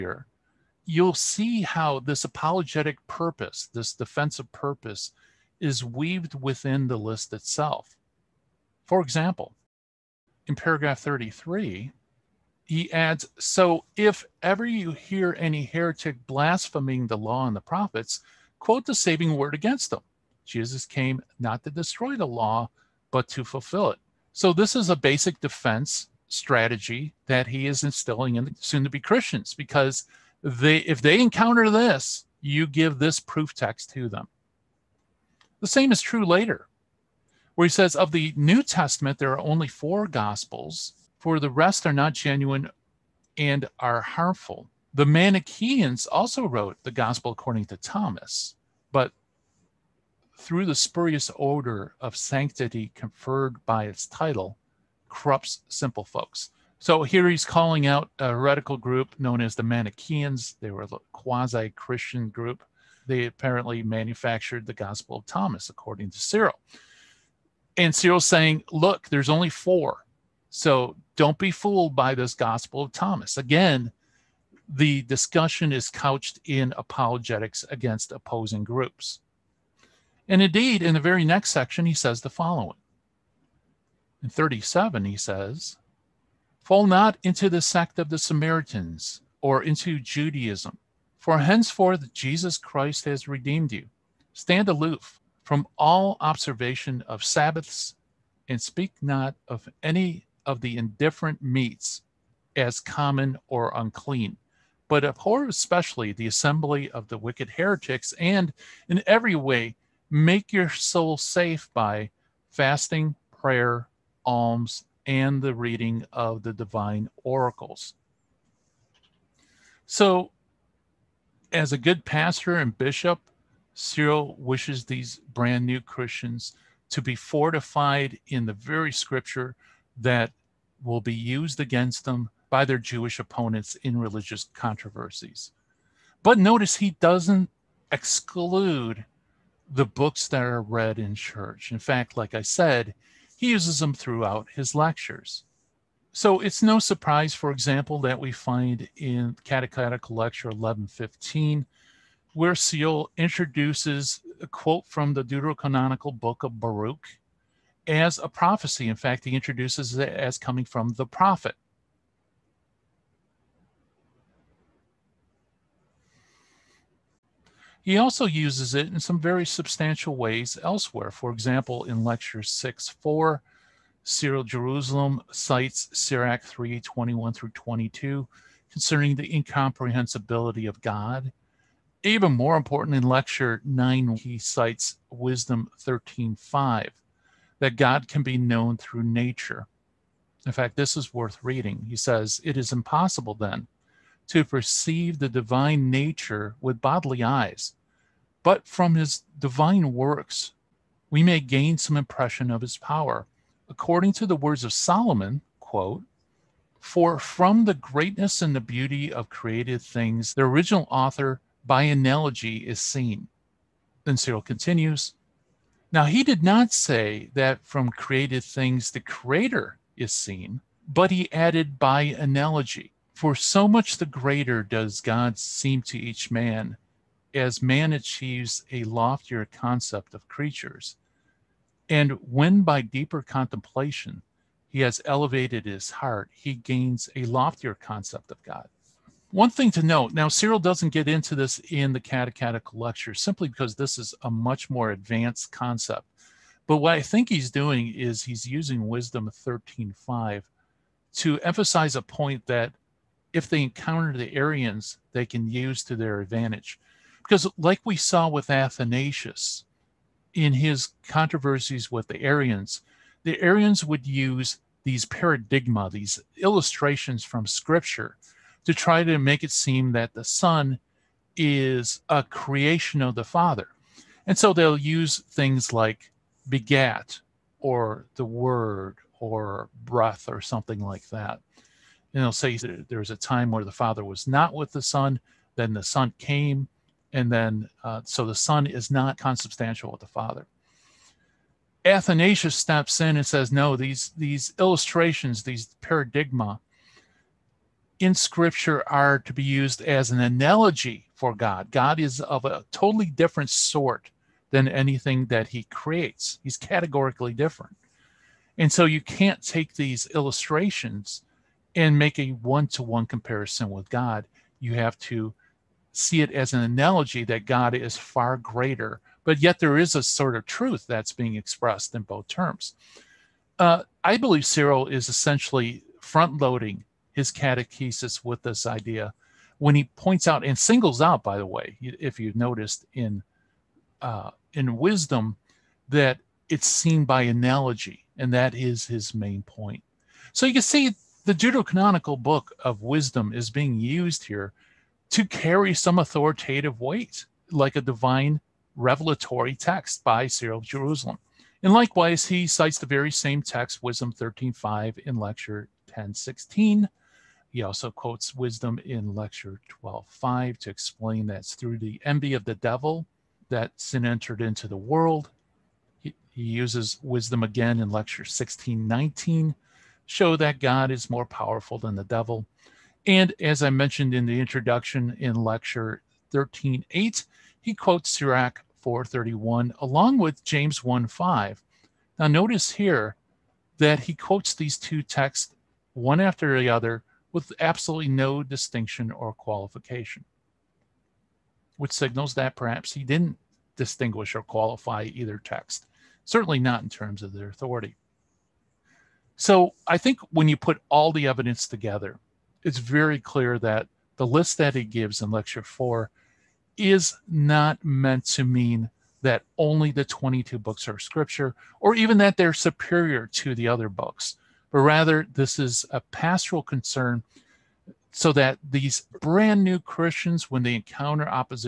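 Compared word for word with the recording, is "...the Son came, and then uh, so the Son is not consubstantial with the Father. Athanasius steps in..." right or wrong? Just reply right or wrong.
right.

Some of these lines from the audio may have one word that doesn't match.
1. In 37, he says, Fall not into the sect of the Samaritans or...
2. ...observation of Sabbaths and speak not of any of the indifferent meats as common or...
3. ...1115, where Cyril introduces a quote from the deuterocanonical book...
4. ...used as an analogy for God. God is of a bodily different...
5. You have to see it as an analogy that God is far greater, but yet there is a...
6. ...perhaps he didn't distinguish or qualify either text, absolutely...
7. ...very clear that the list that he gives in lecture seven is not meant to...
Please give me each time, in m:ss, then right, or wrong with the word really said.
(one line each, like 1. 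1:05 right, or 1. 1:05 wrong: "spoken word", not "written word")
1. 1:24 right
2. 1:36 right
3. 2:30 right
4. 4:59 wrong: "totally", not "bodily"
5. 5:14 right
6. 6:32 wrong: "certainly", not "absolutely"
7. 6:42 wrong: "four", not "seven".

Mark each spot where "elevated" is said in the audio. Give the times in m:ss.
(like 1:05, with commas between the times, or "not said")
3:55.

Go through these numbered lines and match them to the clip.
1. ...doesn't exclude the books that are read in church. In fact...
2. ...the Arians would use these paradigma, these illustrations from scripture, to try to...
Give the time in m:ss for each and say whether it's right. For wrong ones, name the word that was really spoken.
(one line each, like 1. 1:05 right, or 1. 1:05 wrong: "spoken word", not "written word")
1. 2:17 right
2. 4:23 right.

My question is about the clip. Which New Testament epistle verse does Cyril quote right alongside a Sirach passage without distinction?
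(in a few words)
James 1:5.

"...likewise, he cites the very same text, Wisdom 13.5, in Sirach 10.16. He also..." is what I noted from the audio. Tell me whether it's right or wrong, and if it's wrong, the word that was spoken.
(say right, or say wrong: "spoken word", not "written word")
wrong: "Lecture", not "Sirach".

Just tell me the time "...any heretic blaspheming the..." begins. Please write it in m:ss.
0:15.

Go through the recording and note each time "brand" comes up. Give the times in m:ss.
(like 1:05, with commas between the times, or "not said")
2:05, 6:59.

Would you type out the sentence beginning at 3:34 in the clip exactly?
Then Cyril continues Now he did not say that from created things the Creator is seen, but he added by analogy.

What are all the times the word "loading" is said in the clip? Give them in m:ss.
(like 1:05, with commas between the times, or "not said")
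5:26.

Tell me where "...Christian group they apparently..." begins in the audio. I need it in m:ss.
1:01.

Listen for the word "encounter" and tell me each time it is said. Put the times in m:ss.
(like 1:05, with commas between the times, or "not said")
0:31, 4:13, 7:00.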